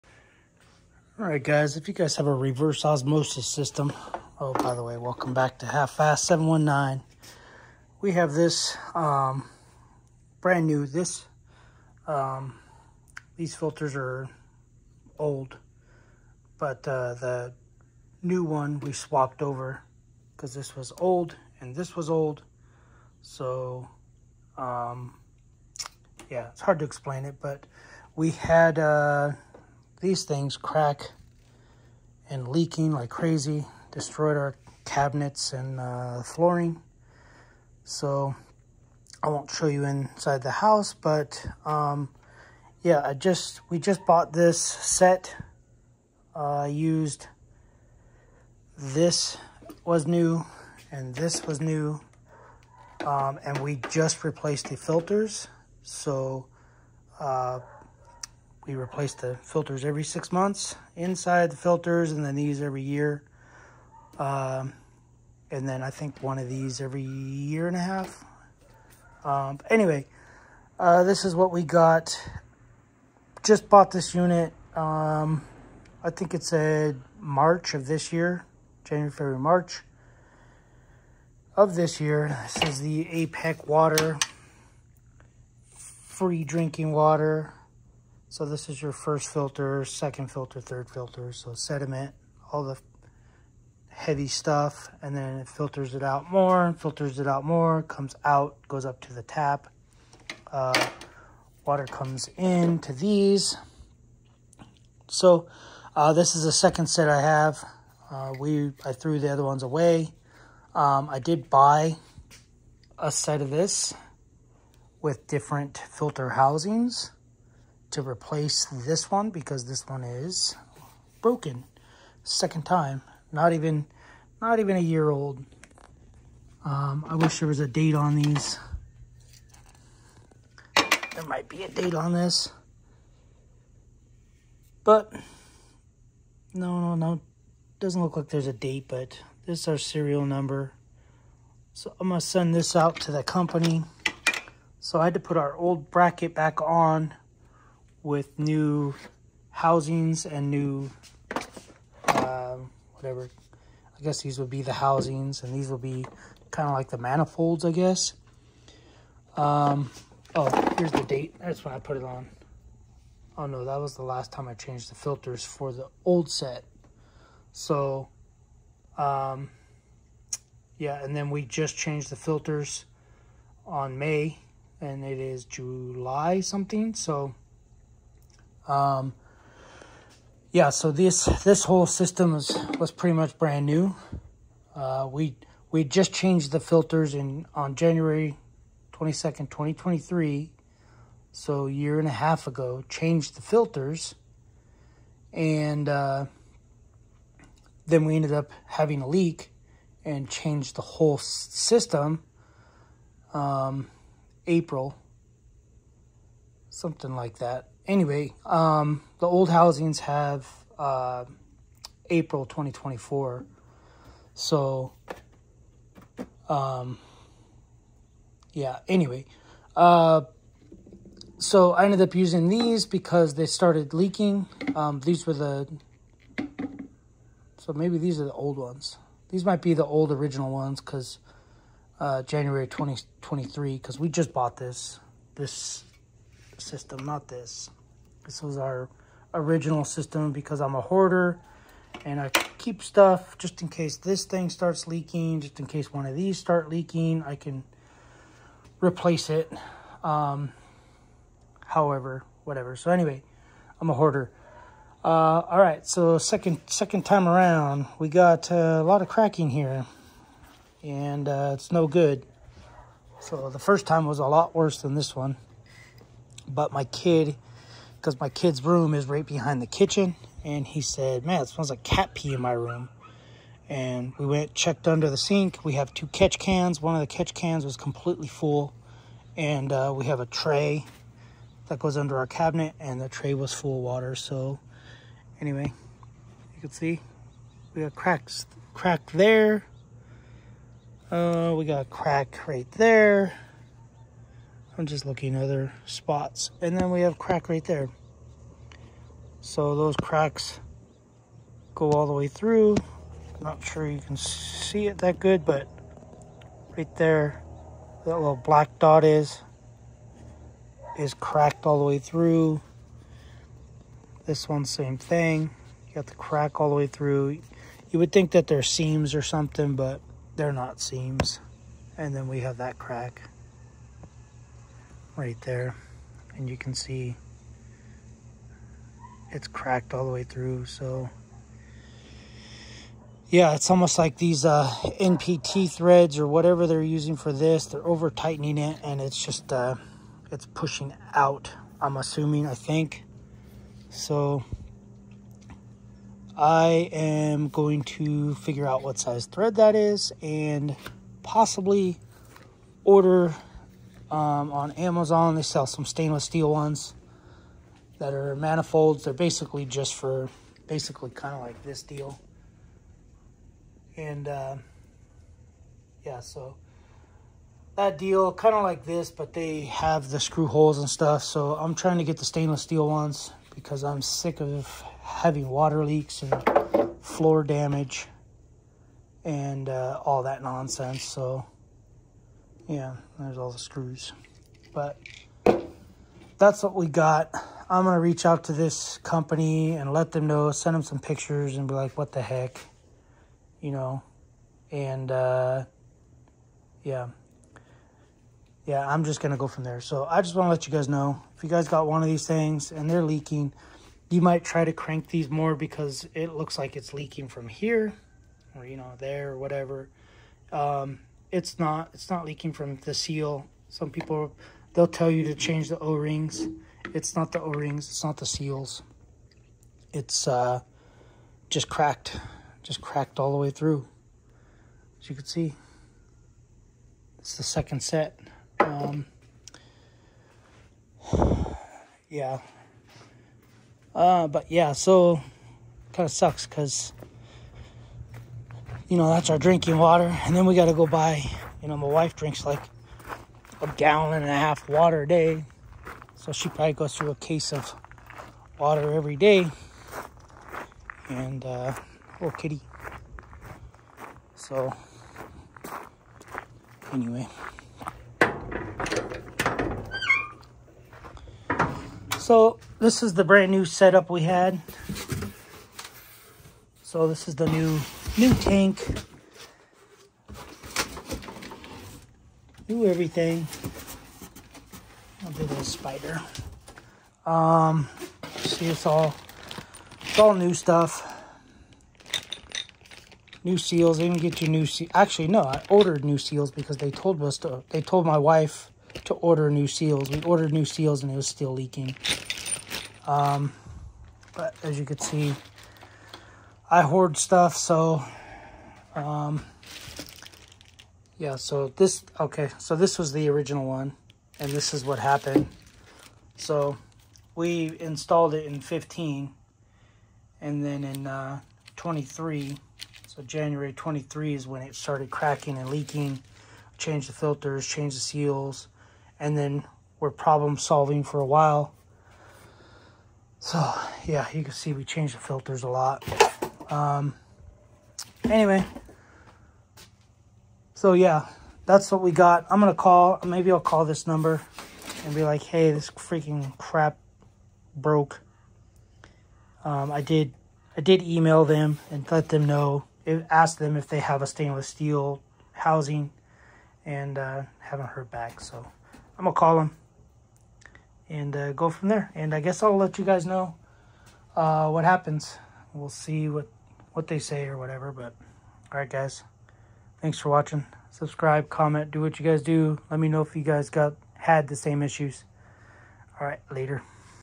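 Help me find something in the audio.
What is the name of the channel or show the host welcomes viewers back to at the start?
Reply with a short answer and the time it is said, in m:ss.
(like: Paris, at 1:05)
Half Fast 719, at 0:05.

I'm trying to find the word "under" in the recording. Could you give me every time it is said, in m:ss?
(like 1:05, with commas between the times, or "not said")
4:34, 4:41.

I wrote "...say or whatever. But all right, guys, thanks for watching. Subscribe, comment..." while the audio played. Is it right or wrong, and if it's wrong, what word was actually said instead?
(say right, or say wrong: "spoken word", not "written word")
right.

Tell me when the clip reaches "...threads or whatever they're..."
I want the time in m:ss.
5:35.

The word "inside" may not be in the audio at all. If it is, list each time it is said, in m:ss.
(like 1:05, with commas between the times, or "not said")
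0:39, 1:00.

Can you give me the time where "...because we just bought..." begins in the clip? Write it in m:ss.
3:53.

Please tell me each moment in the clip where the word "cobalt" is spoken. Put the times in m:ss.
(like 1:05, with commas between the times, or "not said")
not said.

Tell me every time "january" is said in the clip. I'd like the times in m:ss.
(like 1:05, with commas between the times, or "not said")
1:18, 3:07, 3:52, 8:33.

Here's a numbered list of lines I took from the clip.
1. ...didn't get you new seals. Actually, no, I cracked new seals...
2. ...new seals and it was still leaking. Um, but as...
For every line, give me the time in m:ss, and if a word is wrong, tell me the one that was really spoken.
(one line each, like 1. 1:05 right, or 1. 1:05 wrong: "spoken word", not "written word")
1. 8:04 wrong: "ordered", not "cracked"
2. 8:10 right.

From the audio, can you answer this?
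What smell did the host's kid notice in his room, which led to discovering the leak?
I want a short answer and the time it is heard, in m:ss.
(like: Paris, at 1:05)
cat pee, at 4:31.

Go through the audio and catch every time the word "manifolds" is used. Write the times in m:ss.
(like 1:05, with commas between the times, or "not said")
2:36, 5:58.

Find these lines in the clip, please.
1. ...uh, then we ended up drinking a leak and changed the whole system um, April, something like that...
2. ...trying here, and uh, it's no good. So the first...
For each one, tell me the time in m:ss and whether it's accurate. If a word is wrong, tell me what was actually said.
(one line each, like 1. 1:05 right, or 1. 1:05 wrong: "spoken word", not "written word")
1. 3:15 wrong: "having", not "drinking"
2. 4:19 wrong: "cracking", not "trying".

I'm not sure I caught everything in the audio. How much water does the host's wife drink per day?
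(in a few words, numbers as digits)
a gallon and a half.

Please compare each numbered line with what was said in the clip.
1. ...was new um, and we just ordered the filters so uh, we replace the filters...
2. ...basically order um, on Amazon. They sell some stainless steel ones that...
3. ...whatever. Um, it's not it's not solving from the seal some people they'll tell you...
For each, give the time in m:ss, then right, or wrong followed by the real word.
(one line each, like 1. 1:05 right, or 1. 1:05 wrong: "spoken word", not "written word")
1. 0:51 wrong: "replaced", not "ordered"
2. 5:51 wrong: "possibly", not "basically"
3. 6:49 wrong: "leaking", not "solving".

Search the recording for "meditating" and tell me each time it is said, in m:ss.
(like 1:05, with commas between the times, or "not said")
not said.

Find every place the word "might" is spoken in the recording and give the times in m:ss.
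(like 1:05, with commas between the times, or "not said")
2:11, 3:49, 6:44.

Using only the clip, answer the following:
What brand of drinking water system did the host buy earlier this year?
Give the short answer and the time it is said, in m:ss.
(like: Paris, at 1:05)
APEC, at 1:23.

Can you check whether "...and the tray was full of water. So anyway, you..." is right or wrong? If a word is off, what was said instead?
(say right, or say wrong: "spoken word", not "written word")
right.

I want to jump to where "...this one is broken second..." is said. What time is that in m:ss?
1:59.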